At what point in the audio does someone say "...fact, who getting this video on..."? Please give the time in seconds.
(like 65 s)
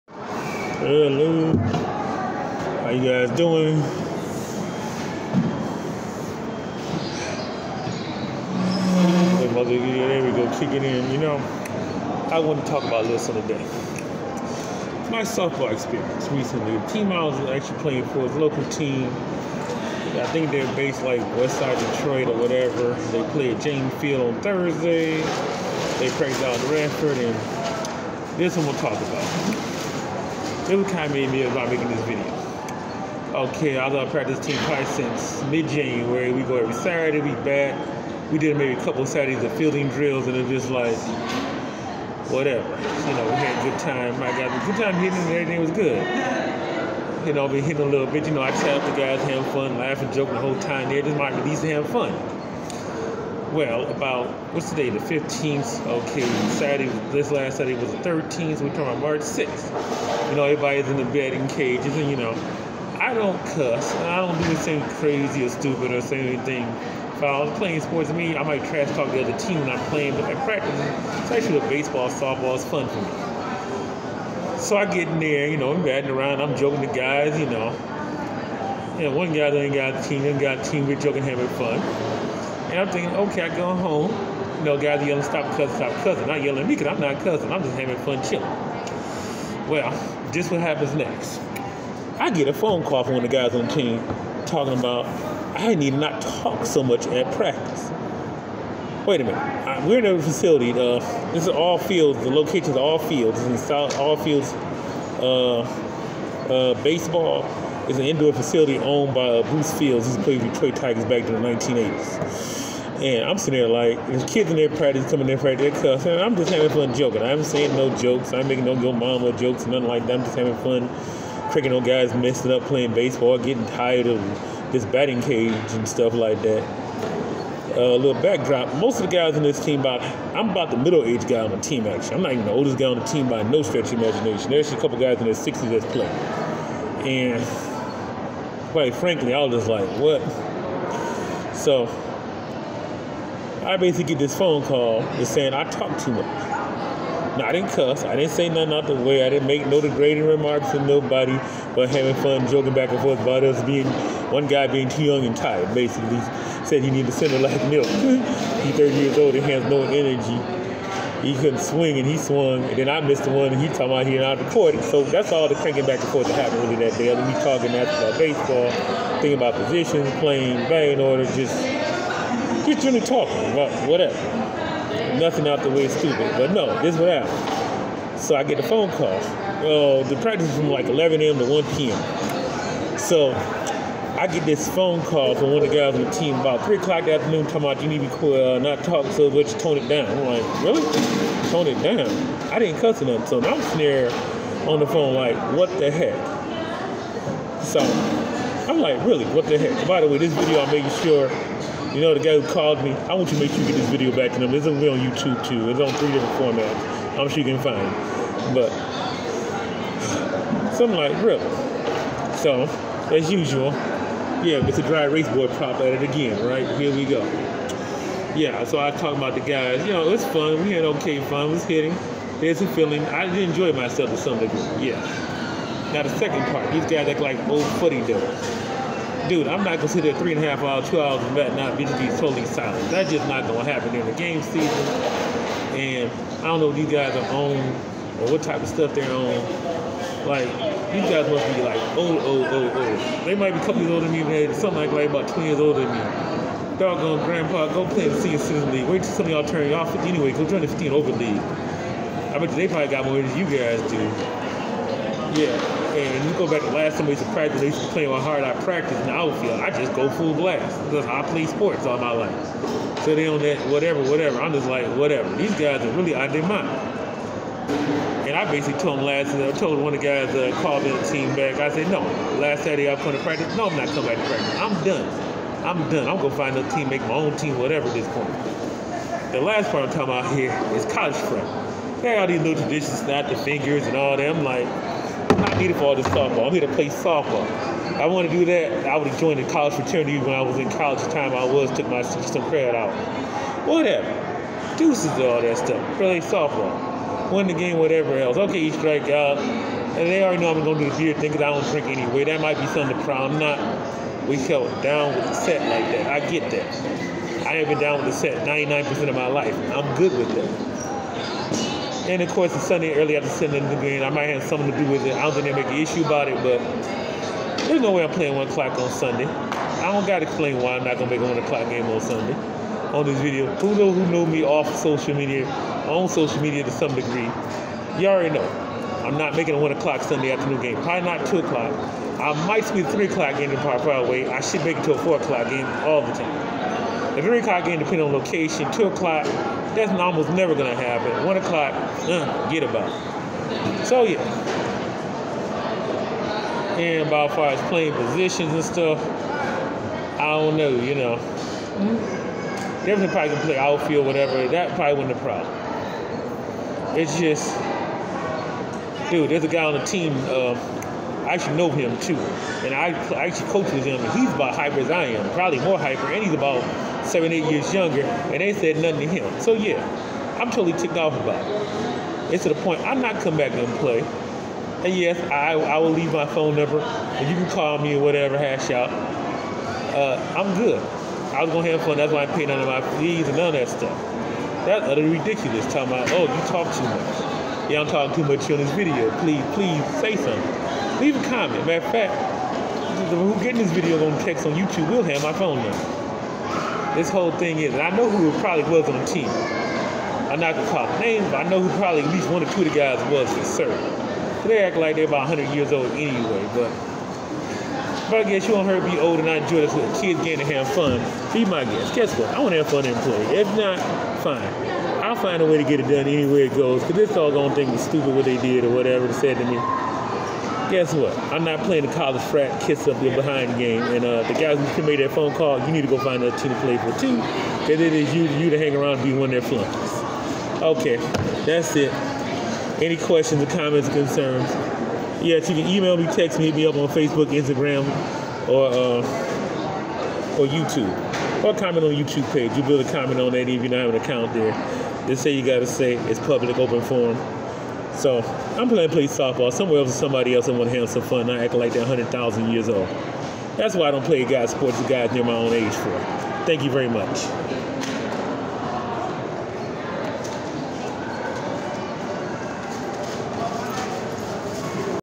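391 s.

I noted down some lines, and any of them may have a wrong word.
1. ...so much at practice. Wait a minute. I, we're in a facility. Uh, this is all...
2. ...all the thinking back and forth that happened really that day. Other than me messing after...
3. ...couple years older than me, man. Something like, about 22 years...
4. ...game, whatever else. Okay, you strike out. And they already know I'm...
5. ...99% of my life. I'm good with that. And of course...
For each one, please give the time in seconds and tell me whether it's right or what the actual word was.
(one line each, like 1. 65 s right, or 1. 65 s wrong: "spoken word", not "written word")
1. 96 s right
2. 165 s wrong: "talking", not "messing"
3. 243 s wrong: "20", not "22"
4. 297 s right
5. 308 s right.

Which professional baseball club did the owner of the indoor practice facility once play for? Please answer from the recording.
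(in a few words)
Detroit Tigers.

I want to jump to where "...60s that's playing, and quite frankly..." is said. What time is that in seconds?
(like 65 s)
135 s.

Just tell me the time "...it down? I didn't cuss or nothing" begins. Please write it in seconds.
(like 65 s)
191 s.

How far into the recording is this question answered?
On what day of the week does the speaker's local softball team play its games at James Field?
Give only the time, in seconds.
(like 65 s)
24 s.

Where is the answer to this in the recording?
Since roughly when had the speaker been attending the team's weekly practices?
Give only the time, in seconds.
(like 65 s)
35 s.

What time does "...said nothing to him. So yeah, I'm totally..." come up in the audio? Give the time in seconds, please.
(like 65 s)
368 s.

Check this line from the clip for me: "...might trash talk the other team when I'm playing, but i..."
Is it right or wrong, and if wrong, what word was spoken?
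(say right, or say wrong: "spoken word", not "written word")
right.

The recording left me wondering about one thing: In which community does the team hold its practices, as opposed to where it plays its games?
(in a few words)
Redford.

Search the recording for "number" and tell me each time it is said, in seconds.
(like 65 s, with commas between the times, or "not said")
376 s, 395 s.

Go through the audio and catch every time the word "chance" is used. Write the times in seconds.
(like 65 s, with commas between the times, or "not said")
not said.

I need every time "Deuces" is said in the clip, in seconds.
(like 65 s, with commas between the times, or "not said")
294 s.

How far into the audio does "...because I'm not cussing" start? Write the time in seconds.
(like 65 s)
86 s.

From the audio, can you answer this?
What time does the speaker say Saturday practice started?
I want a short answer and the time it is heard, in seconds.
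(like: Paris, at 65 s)
11 a.m., at 180 s.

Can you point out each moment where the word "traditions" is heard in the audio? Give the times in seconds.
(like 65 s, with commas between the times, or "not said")
282 s.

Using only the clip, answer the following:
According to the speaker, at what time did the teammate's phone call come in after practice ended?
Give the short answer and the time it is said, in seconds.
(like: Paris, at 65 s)
3 o'clock, at 186 s.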